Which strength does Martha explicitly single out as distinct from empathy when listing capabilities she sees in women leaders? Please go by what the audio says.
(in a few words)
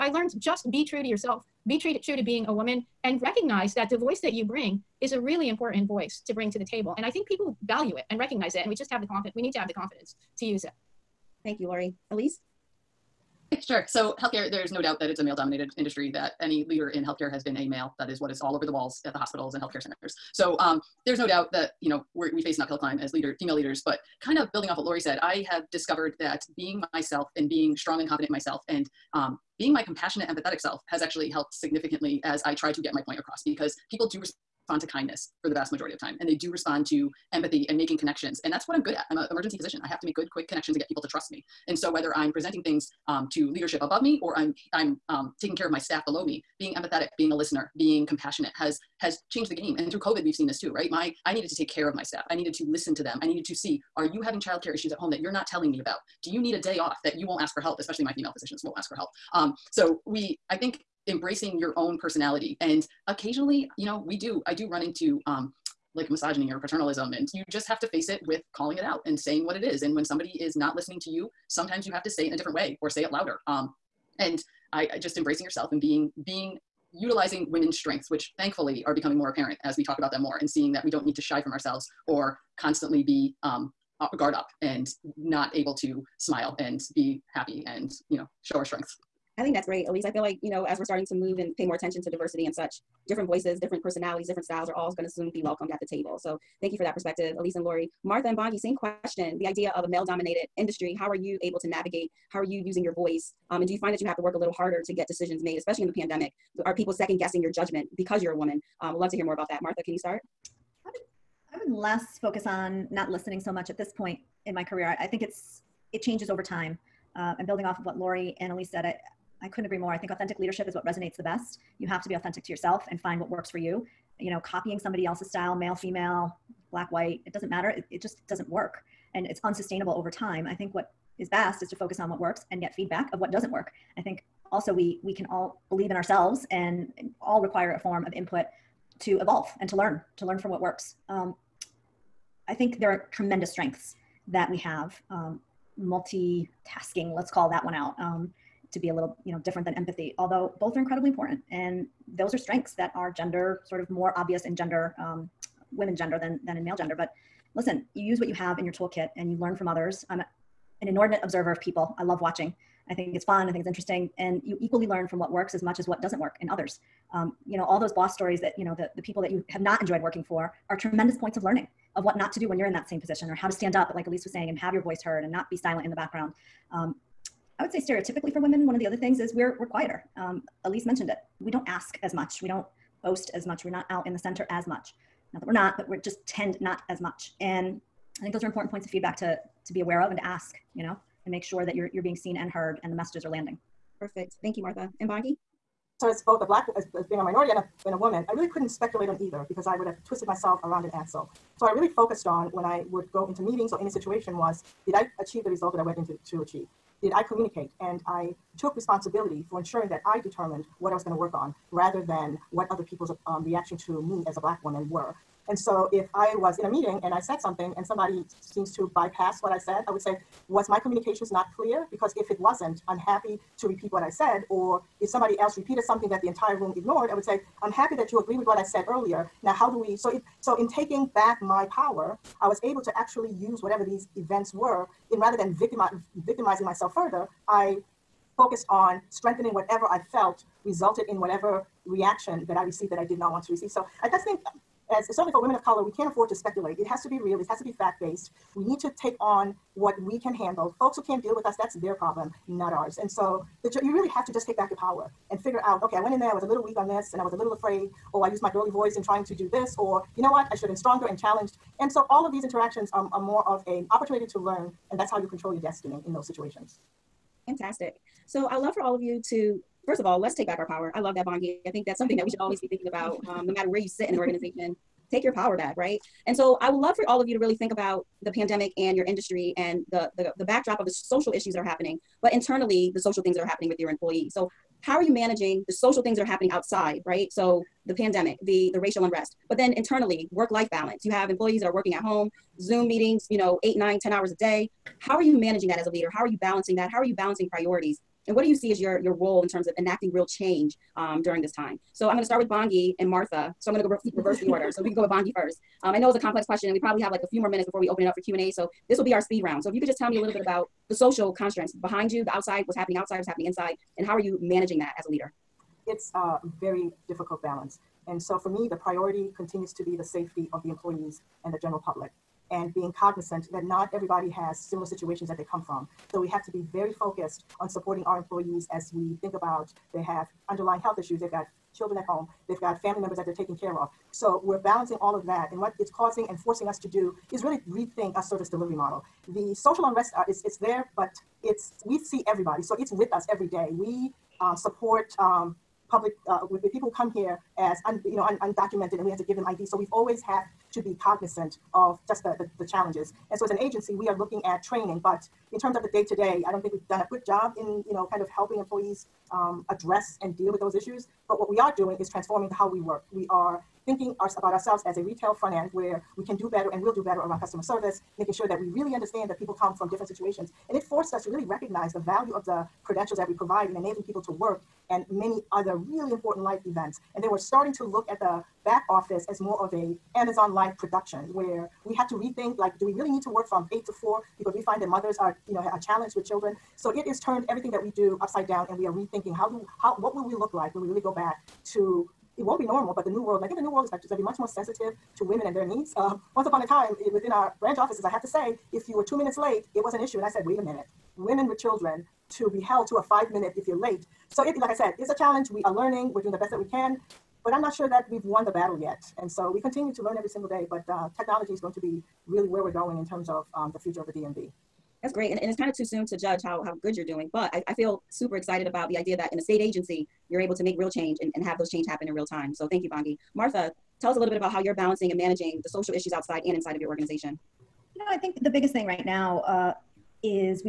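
Multi tasking.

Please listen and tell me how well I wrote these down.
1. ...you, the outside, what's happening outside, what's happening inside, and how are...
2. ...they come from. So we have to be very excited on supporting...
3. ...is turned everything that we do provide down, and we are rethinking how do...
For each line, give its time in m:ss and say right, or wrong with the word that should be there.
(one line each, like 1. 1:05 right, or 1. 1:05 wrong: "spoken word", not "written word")
1. 5:12 right
2. 5:25 wrong: "focused", not "excited"
3. 6:27 wrong: "upside", not "provide".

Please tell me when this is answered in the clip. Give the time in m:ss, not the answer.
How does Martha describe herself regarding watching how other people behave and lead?
2:40.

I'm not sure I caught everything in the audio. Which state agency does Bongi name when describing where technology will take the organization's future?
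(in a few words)
DMV.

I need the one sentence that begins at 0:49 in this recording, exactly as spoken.
And through COVID, we've seen this too, right?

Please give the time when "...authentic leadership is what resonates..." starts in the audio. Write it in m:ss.
2:00.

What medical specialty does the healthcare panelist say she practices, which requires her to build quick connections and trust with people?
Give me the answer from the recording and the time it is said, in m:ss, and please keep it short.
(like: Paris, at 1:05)
Emergency physician, at 0:39.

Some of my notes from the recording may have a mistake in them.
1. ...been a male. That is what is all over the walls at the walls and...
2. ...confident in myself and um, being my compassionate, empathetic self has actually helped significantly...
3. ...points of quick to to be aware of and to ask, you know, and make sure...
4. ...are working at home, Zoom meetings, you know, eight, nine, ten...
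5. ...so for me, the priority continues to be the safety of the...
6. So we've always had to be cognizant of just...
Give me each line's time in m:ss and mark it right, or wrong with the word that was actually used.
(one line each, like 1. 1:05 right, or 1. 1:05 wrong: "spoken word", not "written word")
1. 0:17 wrong: "hospitals", not "walls"
2. 0:28 right
3. 3:08 wrong: "feedback", not "quick"
4. 4:51 right
5. 5:18 right
6. 5:49 right.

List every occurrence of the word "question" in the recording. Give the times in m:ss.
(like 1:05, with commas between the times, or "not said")
1:38, 5:06.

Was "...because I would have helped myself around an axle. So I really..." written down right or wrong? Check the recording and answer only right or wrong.
wrong.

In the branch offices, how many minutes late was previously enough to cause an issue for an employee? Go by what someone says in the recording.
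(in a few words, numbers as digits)
2.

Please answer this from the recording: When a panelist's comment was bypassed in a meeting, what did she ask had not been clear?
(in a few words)
My communications.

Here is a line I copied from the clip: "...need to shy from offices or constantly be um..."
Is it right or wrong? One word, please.
wrong.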